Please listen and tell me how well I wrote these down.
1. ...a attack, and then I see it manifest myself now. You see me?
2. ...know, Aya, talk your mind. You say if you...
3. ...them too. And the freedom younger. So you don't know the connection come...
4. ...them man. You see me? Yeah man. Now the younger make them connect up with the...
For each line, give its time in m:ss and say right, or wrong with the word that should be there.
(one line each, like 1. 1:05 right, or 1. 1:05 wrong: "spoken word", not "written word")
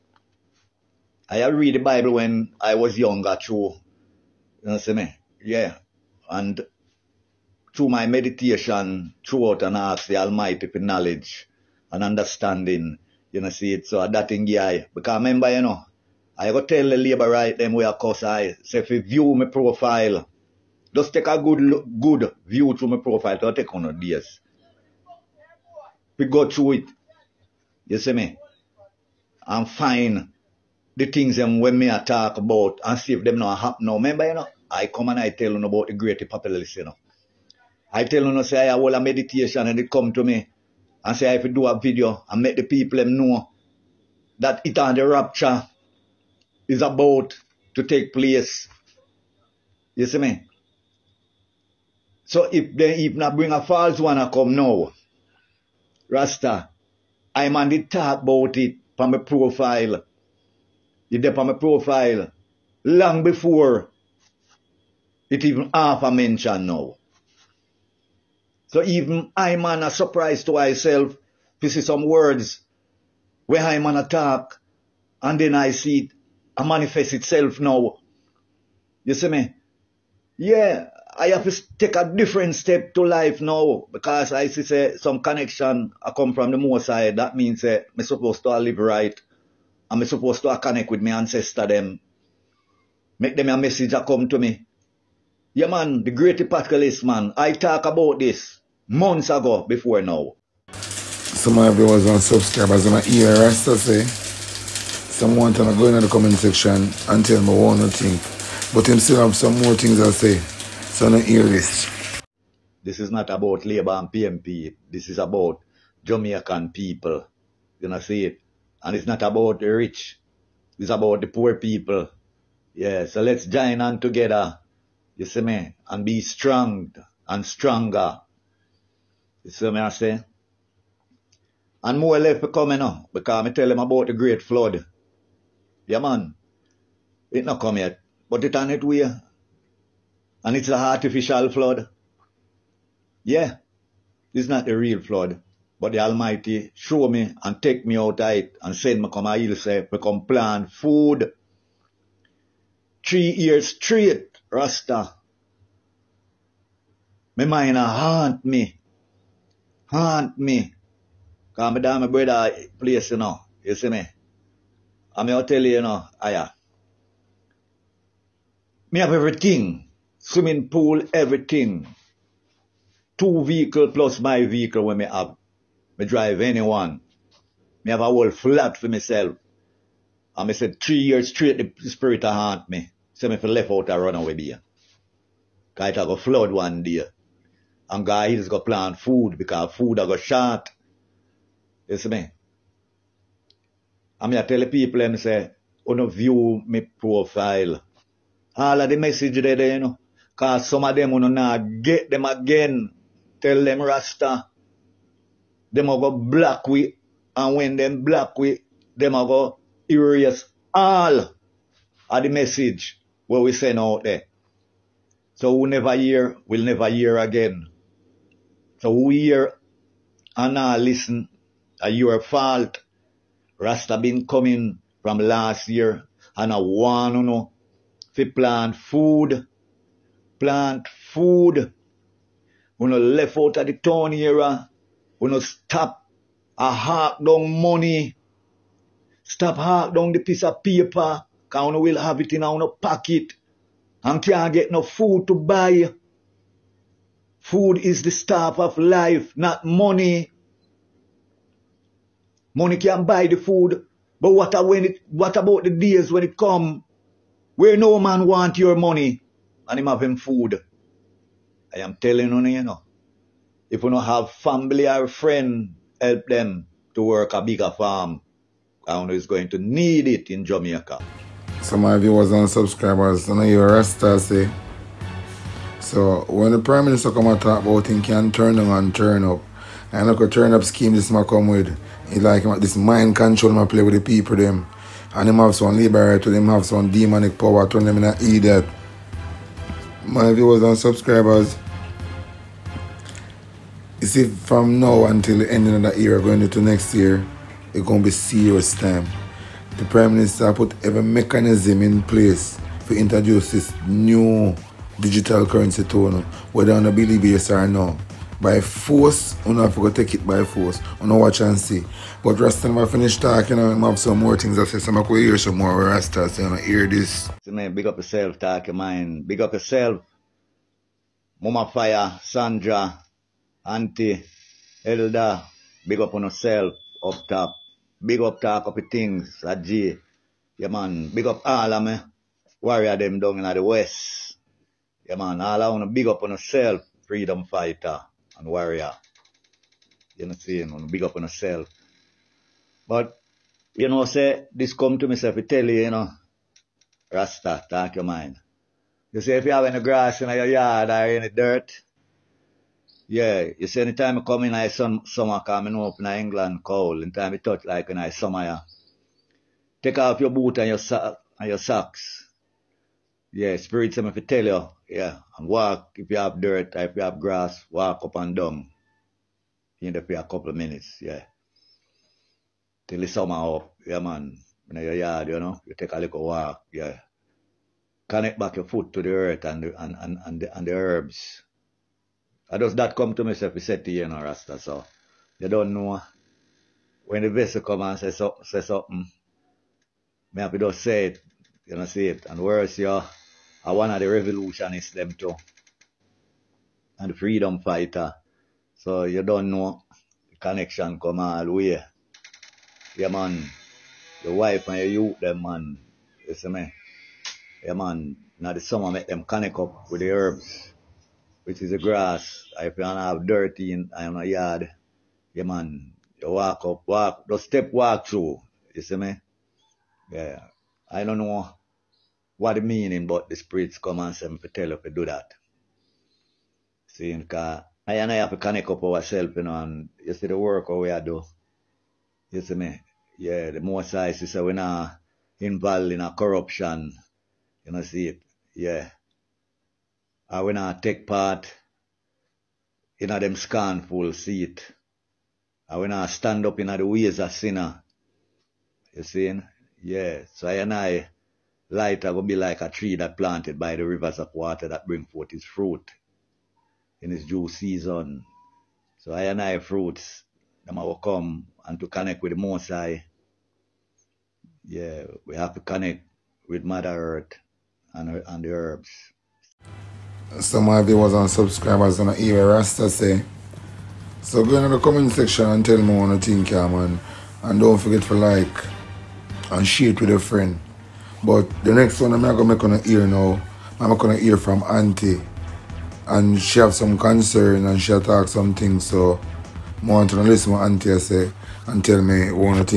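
1. 1:13 wrong: "itself", not "myself"
2. 5:45 wrong: "Rasta", not "Aya"
3. 6:34 wrong: "fighter", not "younger"
4. 6:45 wrong: "summer", not "younger".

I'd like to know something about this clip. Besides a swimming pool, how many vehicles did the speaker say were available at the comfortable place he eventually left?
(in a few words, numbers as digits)
2.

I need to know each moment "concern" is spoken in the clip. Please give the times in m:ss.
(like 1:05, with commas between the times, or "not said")
8:06.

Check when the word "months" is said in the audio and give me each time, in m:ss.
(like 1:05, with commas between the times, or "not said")
1:38.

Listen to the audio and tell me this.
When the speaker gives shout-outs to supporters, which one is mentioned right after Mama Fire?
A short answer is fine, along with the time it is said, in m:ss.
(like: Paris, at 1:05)
Sandra, at 5:22.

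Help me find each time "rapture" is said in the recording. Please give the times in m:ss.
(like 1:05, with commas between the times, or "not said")
0:45.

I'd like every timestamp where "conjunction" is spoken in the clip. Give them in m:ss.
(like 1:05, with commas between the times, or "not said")
not said.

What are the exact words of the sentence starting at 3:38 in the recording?
So we hear and now listen, are uh, your fault.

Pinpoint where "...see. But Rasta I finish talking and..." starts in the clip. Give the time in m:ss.
5:11.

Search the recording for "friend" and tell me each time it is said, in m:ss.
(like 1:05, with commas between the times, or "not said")
4:25, 8:00.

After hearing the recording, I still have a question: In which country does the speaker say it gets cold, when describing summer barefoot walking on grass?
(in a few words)
England.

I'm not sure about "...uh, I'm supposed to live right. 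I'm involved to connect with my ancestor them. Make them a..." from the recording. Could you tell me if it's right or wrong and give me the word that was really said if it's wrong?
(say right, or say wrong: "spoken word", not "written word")
wrong: "supposed", not "involved".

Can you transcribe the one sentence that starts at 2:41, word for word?
Come my damn brother place, you know.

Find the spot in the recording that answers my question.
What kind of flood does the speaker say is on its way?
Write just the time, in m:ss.
2:20.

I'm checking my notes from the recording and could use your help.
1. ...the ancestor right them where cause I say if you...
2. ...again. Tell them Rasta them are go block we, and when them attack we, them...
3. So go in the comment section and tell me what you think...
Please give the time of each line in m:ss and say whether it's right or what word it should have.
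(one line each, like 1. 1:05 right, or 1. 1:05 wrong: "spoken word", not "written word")
1. 0:16 wrong: "labor", not "ancestor"
2. 3:22 wrong: "black", not "attack"
3. 7:54 right.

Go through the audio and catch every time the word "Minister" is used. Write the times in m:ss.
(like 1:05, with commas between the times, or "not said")
4:36, 5:00.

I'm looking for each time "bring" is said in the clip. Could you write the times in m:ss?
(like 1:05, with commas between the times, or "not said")
0:53, 7:34.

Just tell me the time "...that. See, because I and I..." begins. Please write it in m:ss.
7:05.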